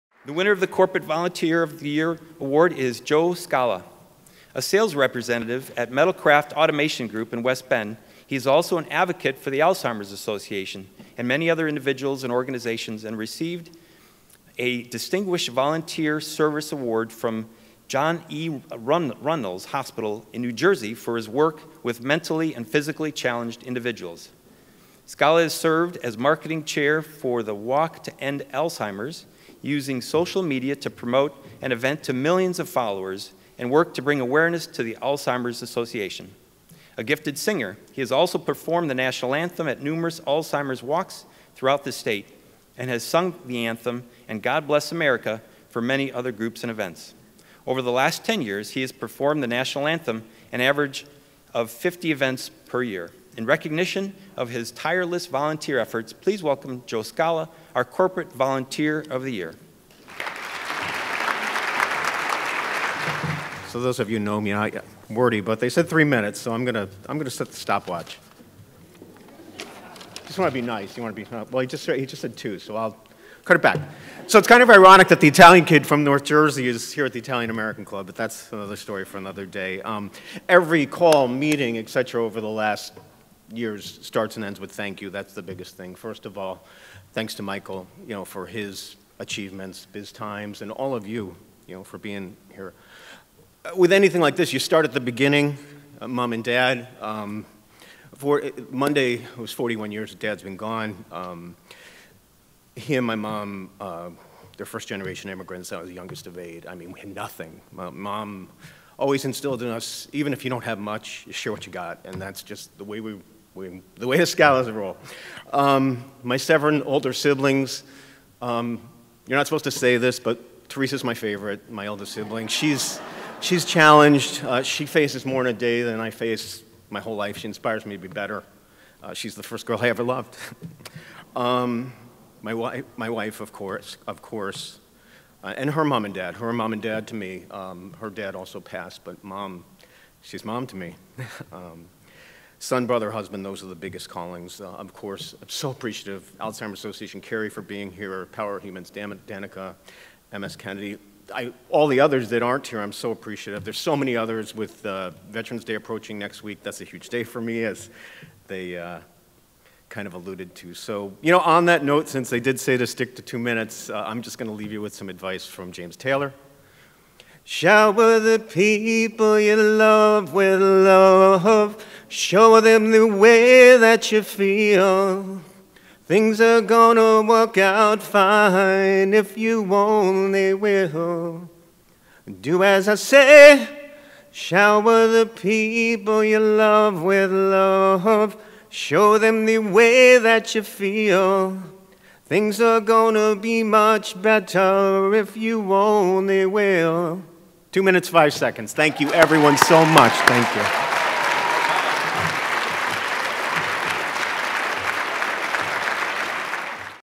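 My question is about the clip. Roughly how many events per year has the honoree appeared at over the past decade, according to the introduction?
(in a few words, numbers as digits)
50.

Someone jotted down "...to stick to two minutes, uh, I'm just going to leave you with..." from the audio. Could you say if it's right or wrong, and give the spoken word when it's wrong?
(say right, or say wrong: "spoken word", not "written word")
right.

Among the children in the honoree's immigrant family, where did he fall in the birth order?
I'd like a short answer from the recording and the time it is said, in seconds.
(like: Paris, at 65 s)
youngest of eight, at 105 s.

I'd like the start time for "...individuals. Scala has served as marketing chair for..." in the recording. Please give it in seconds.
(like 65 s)
23 s.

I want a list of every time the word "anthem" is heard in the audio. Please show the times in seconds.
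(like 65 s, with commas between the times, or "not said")
39 s, 43 s, 49 s.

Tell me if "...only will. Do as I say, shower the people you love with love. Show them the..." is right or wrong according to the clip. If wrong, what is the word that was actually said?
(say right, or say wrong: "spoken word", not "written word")
right.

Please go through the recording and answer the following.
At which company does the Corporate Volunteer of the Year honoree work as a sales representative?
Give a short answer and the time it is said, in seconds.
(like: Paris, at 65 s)
Metalcraft Automation Group, at 5 s.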